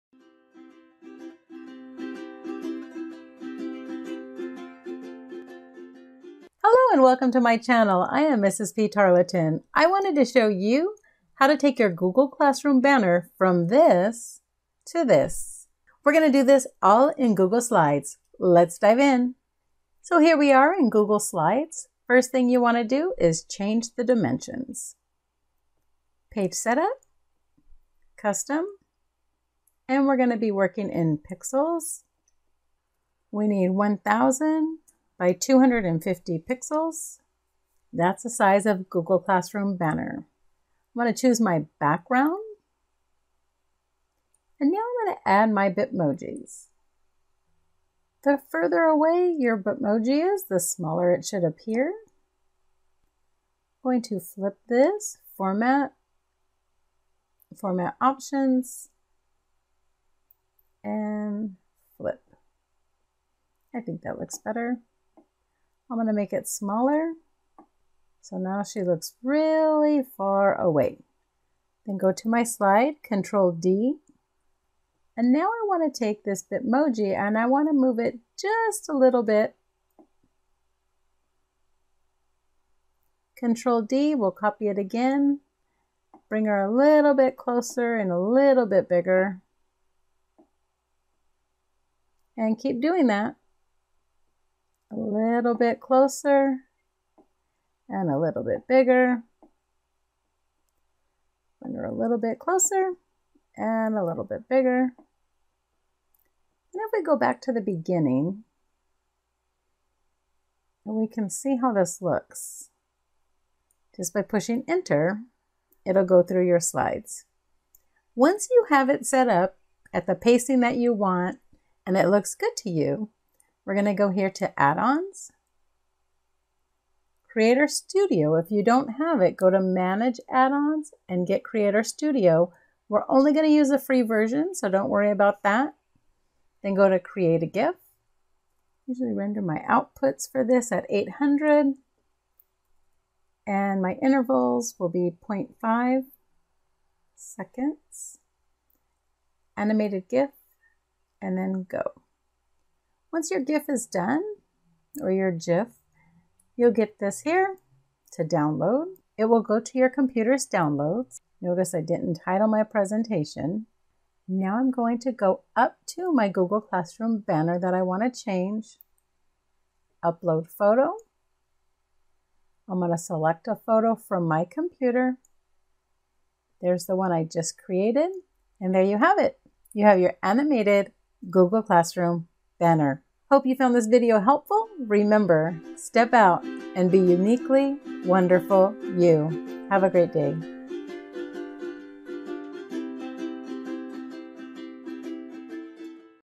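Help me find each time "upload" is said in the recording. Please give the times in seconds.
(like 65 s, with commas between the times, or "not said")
170 s.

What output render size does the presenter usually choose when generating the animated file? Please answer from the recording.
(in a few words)
800.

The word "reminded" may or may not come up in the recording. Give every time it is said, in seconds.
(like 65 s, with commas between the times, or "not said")
not said.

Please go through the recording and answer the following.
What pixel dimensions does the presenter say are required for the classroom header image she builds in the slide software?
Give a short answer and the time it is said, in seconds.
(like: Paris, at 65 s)
1,000 by 250 pixels, at 33 s.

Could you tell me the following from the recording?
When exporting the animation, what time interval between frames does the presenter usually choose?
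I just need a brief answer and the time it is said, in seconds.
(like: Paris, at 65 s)
0.5 seconds, at 145 s.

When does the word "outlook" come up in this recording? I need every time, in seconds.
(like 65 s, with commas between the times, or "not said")
not said.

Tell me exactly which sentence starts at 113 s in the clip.
Just by pushing enter, it'll go through your slides.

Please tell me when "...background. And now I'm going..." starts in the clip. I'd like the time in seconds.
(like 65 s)
41 s.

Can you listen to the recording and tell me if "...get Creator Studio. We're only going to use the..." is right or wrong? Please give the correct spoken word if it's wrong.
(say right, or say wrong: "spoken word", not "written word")
right.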